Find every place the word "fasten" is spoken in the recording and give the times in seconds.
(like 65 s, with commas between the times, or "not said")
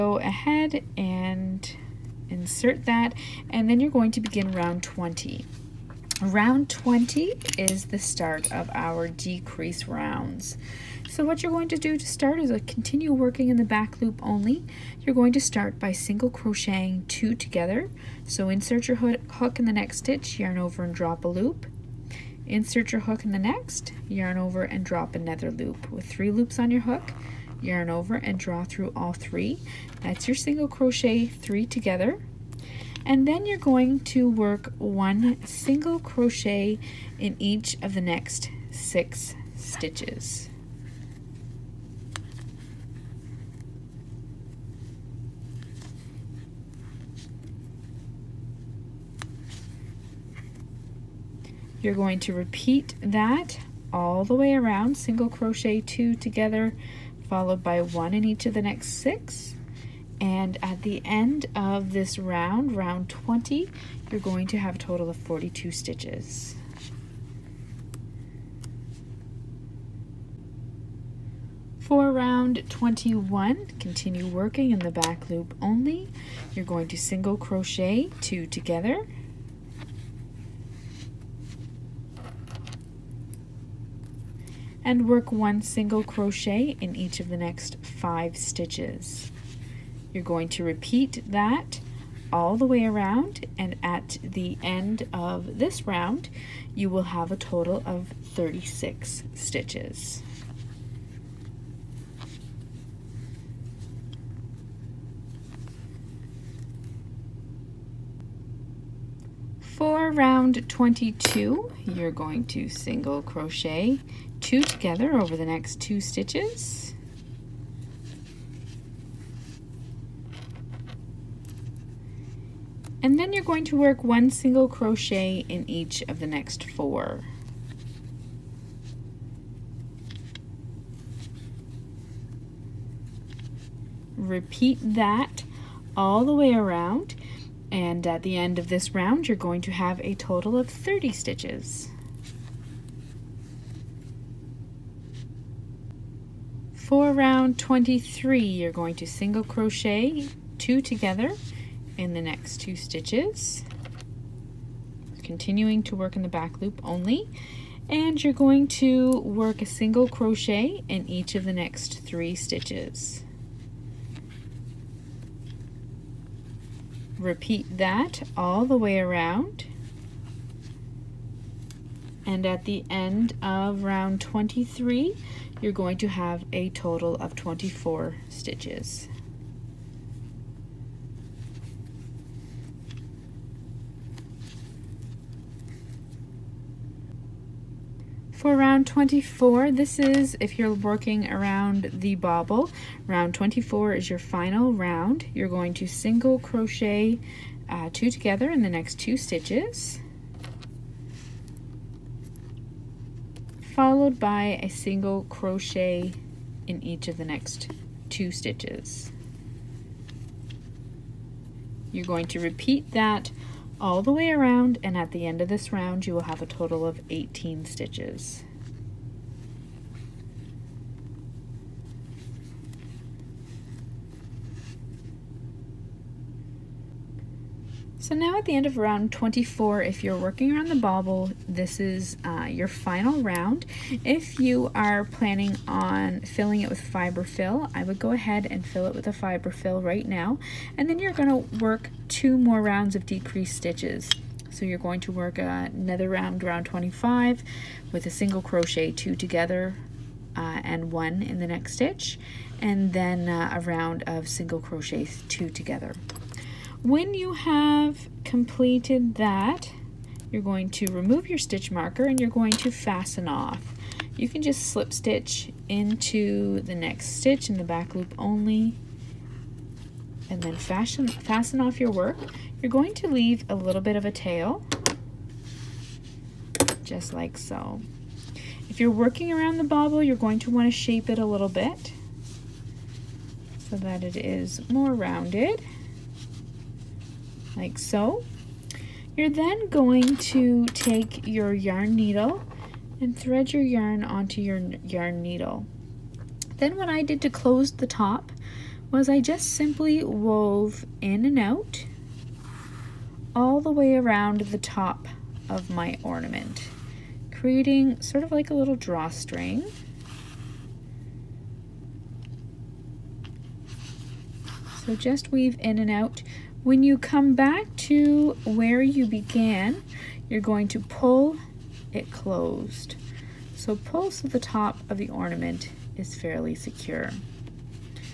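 262 s, 271 s.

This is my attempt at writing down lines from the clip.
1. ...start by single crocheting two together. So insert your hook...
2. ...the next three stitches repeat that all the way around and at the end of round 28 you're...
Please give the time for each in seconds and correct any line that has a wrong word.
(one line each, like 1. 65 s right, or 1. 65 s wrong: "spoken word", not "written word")
1. 15 s right
2. 161 s wrong: "23", not "28".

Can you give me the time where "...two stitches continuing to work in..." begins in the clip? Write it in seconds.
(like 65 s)
152 s.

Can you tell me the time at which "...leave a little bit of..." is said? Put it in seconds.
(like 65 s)
273 s.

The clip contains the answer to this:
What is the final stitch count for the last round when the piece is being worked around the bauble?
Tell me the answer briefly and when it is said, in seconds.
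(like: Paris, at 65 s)
18, at 217 s.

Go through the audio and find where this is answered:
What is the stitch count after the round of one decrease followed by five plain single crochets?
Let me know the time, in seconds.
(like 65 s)
98 s.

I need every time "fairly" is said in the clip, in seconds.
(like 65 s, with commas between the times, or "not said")
326 s.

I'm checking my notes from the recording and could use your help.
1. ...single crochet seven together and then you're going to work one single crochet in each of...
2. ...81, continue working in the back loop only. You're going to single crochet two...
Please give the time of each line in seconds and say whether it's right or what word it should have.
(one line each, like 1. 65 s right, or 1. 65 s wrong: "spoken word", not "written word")
1. 30 s wrong: "three", not "seven"
2. 72 s wrong: "21", not "81".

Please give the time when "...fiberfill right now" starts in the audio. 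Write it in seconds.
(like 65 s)
239 s.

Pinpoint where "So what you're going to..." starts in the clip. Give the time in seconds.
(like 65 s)
11 s.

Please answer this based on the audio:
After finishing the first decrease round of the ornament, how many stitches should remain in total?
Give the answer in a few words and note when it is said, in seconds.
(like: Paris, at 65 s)
42, at 65 s.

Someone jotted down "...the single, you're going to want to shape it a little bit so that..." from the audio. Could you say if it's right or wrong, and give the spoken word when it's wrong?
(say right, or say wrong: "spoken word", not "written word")
wrong: "bobble", not "single".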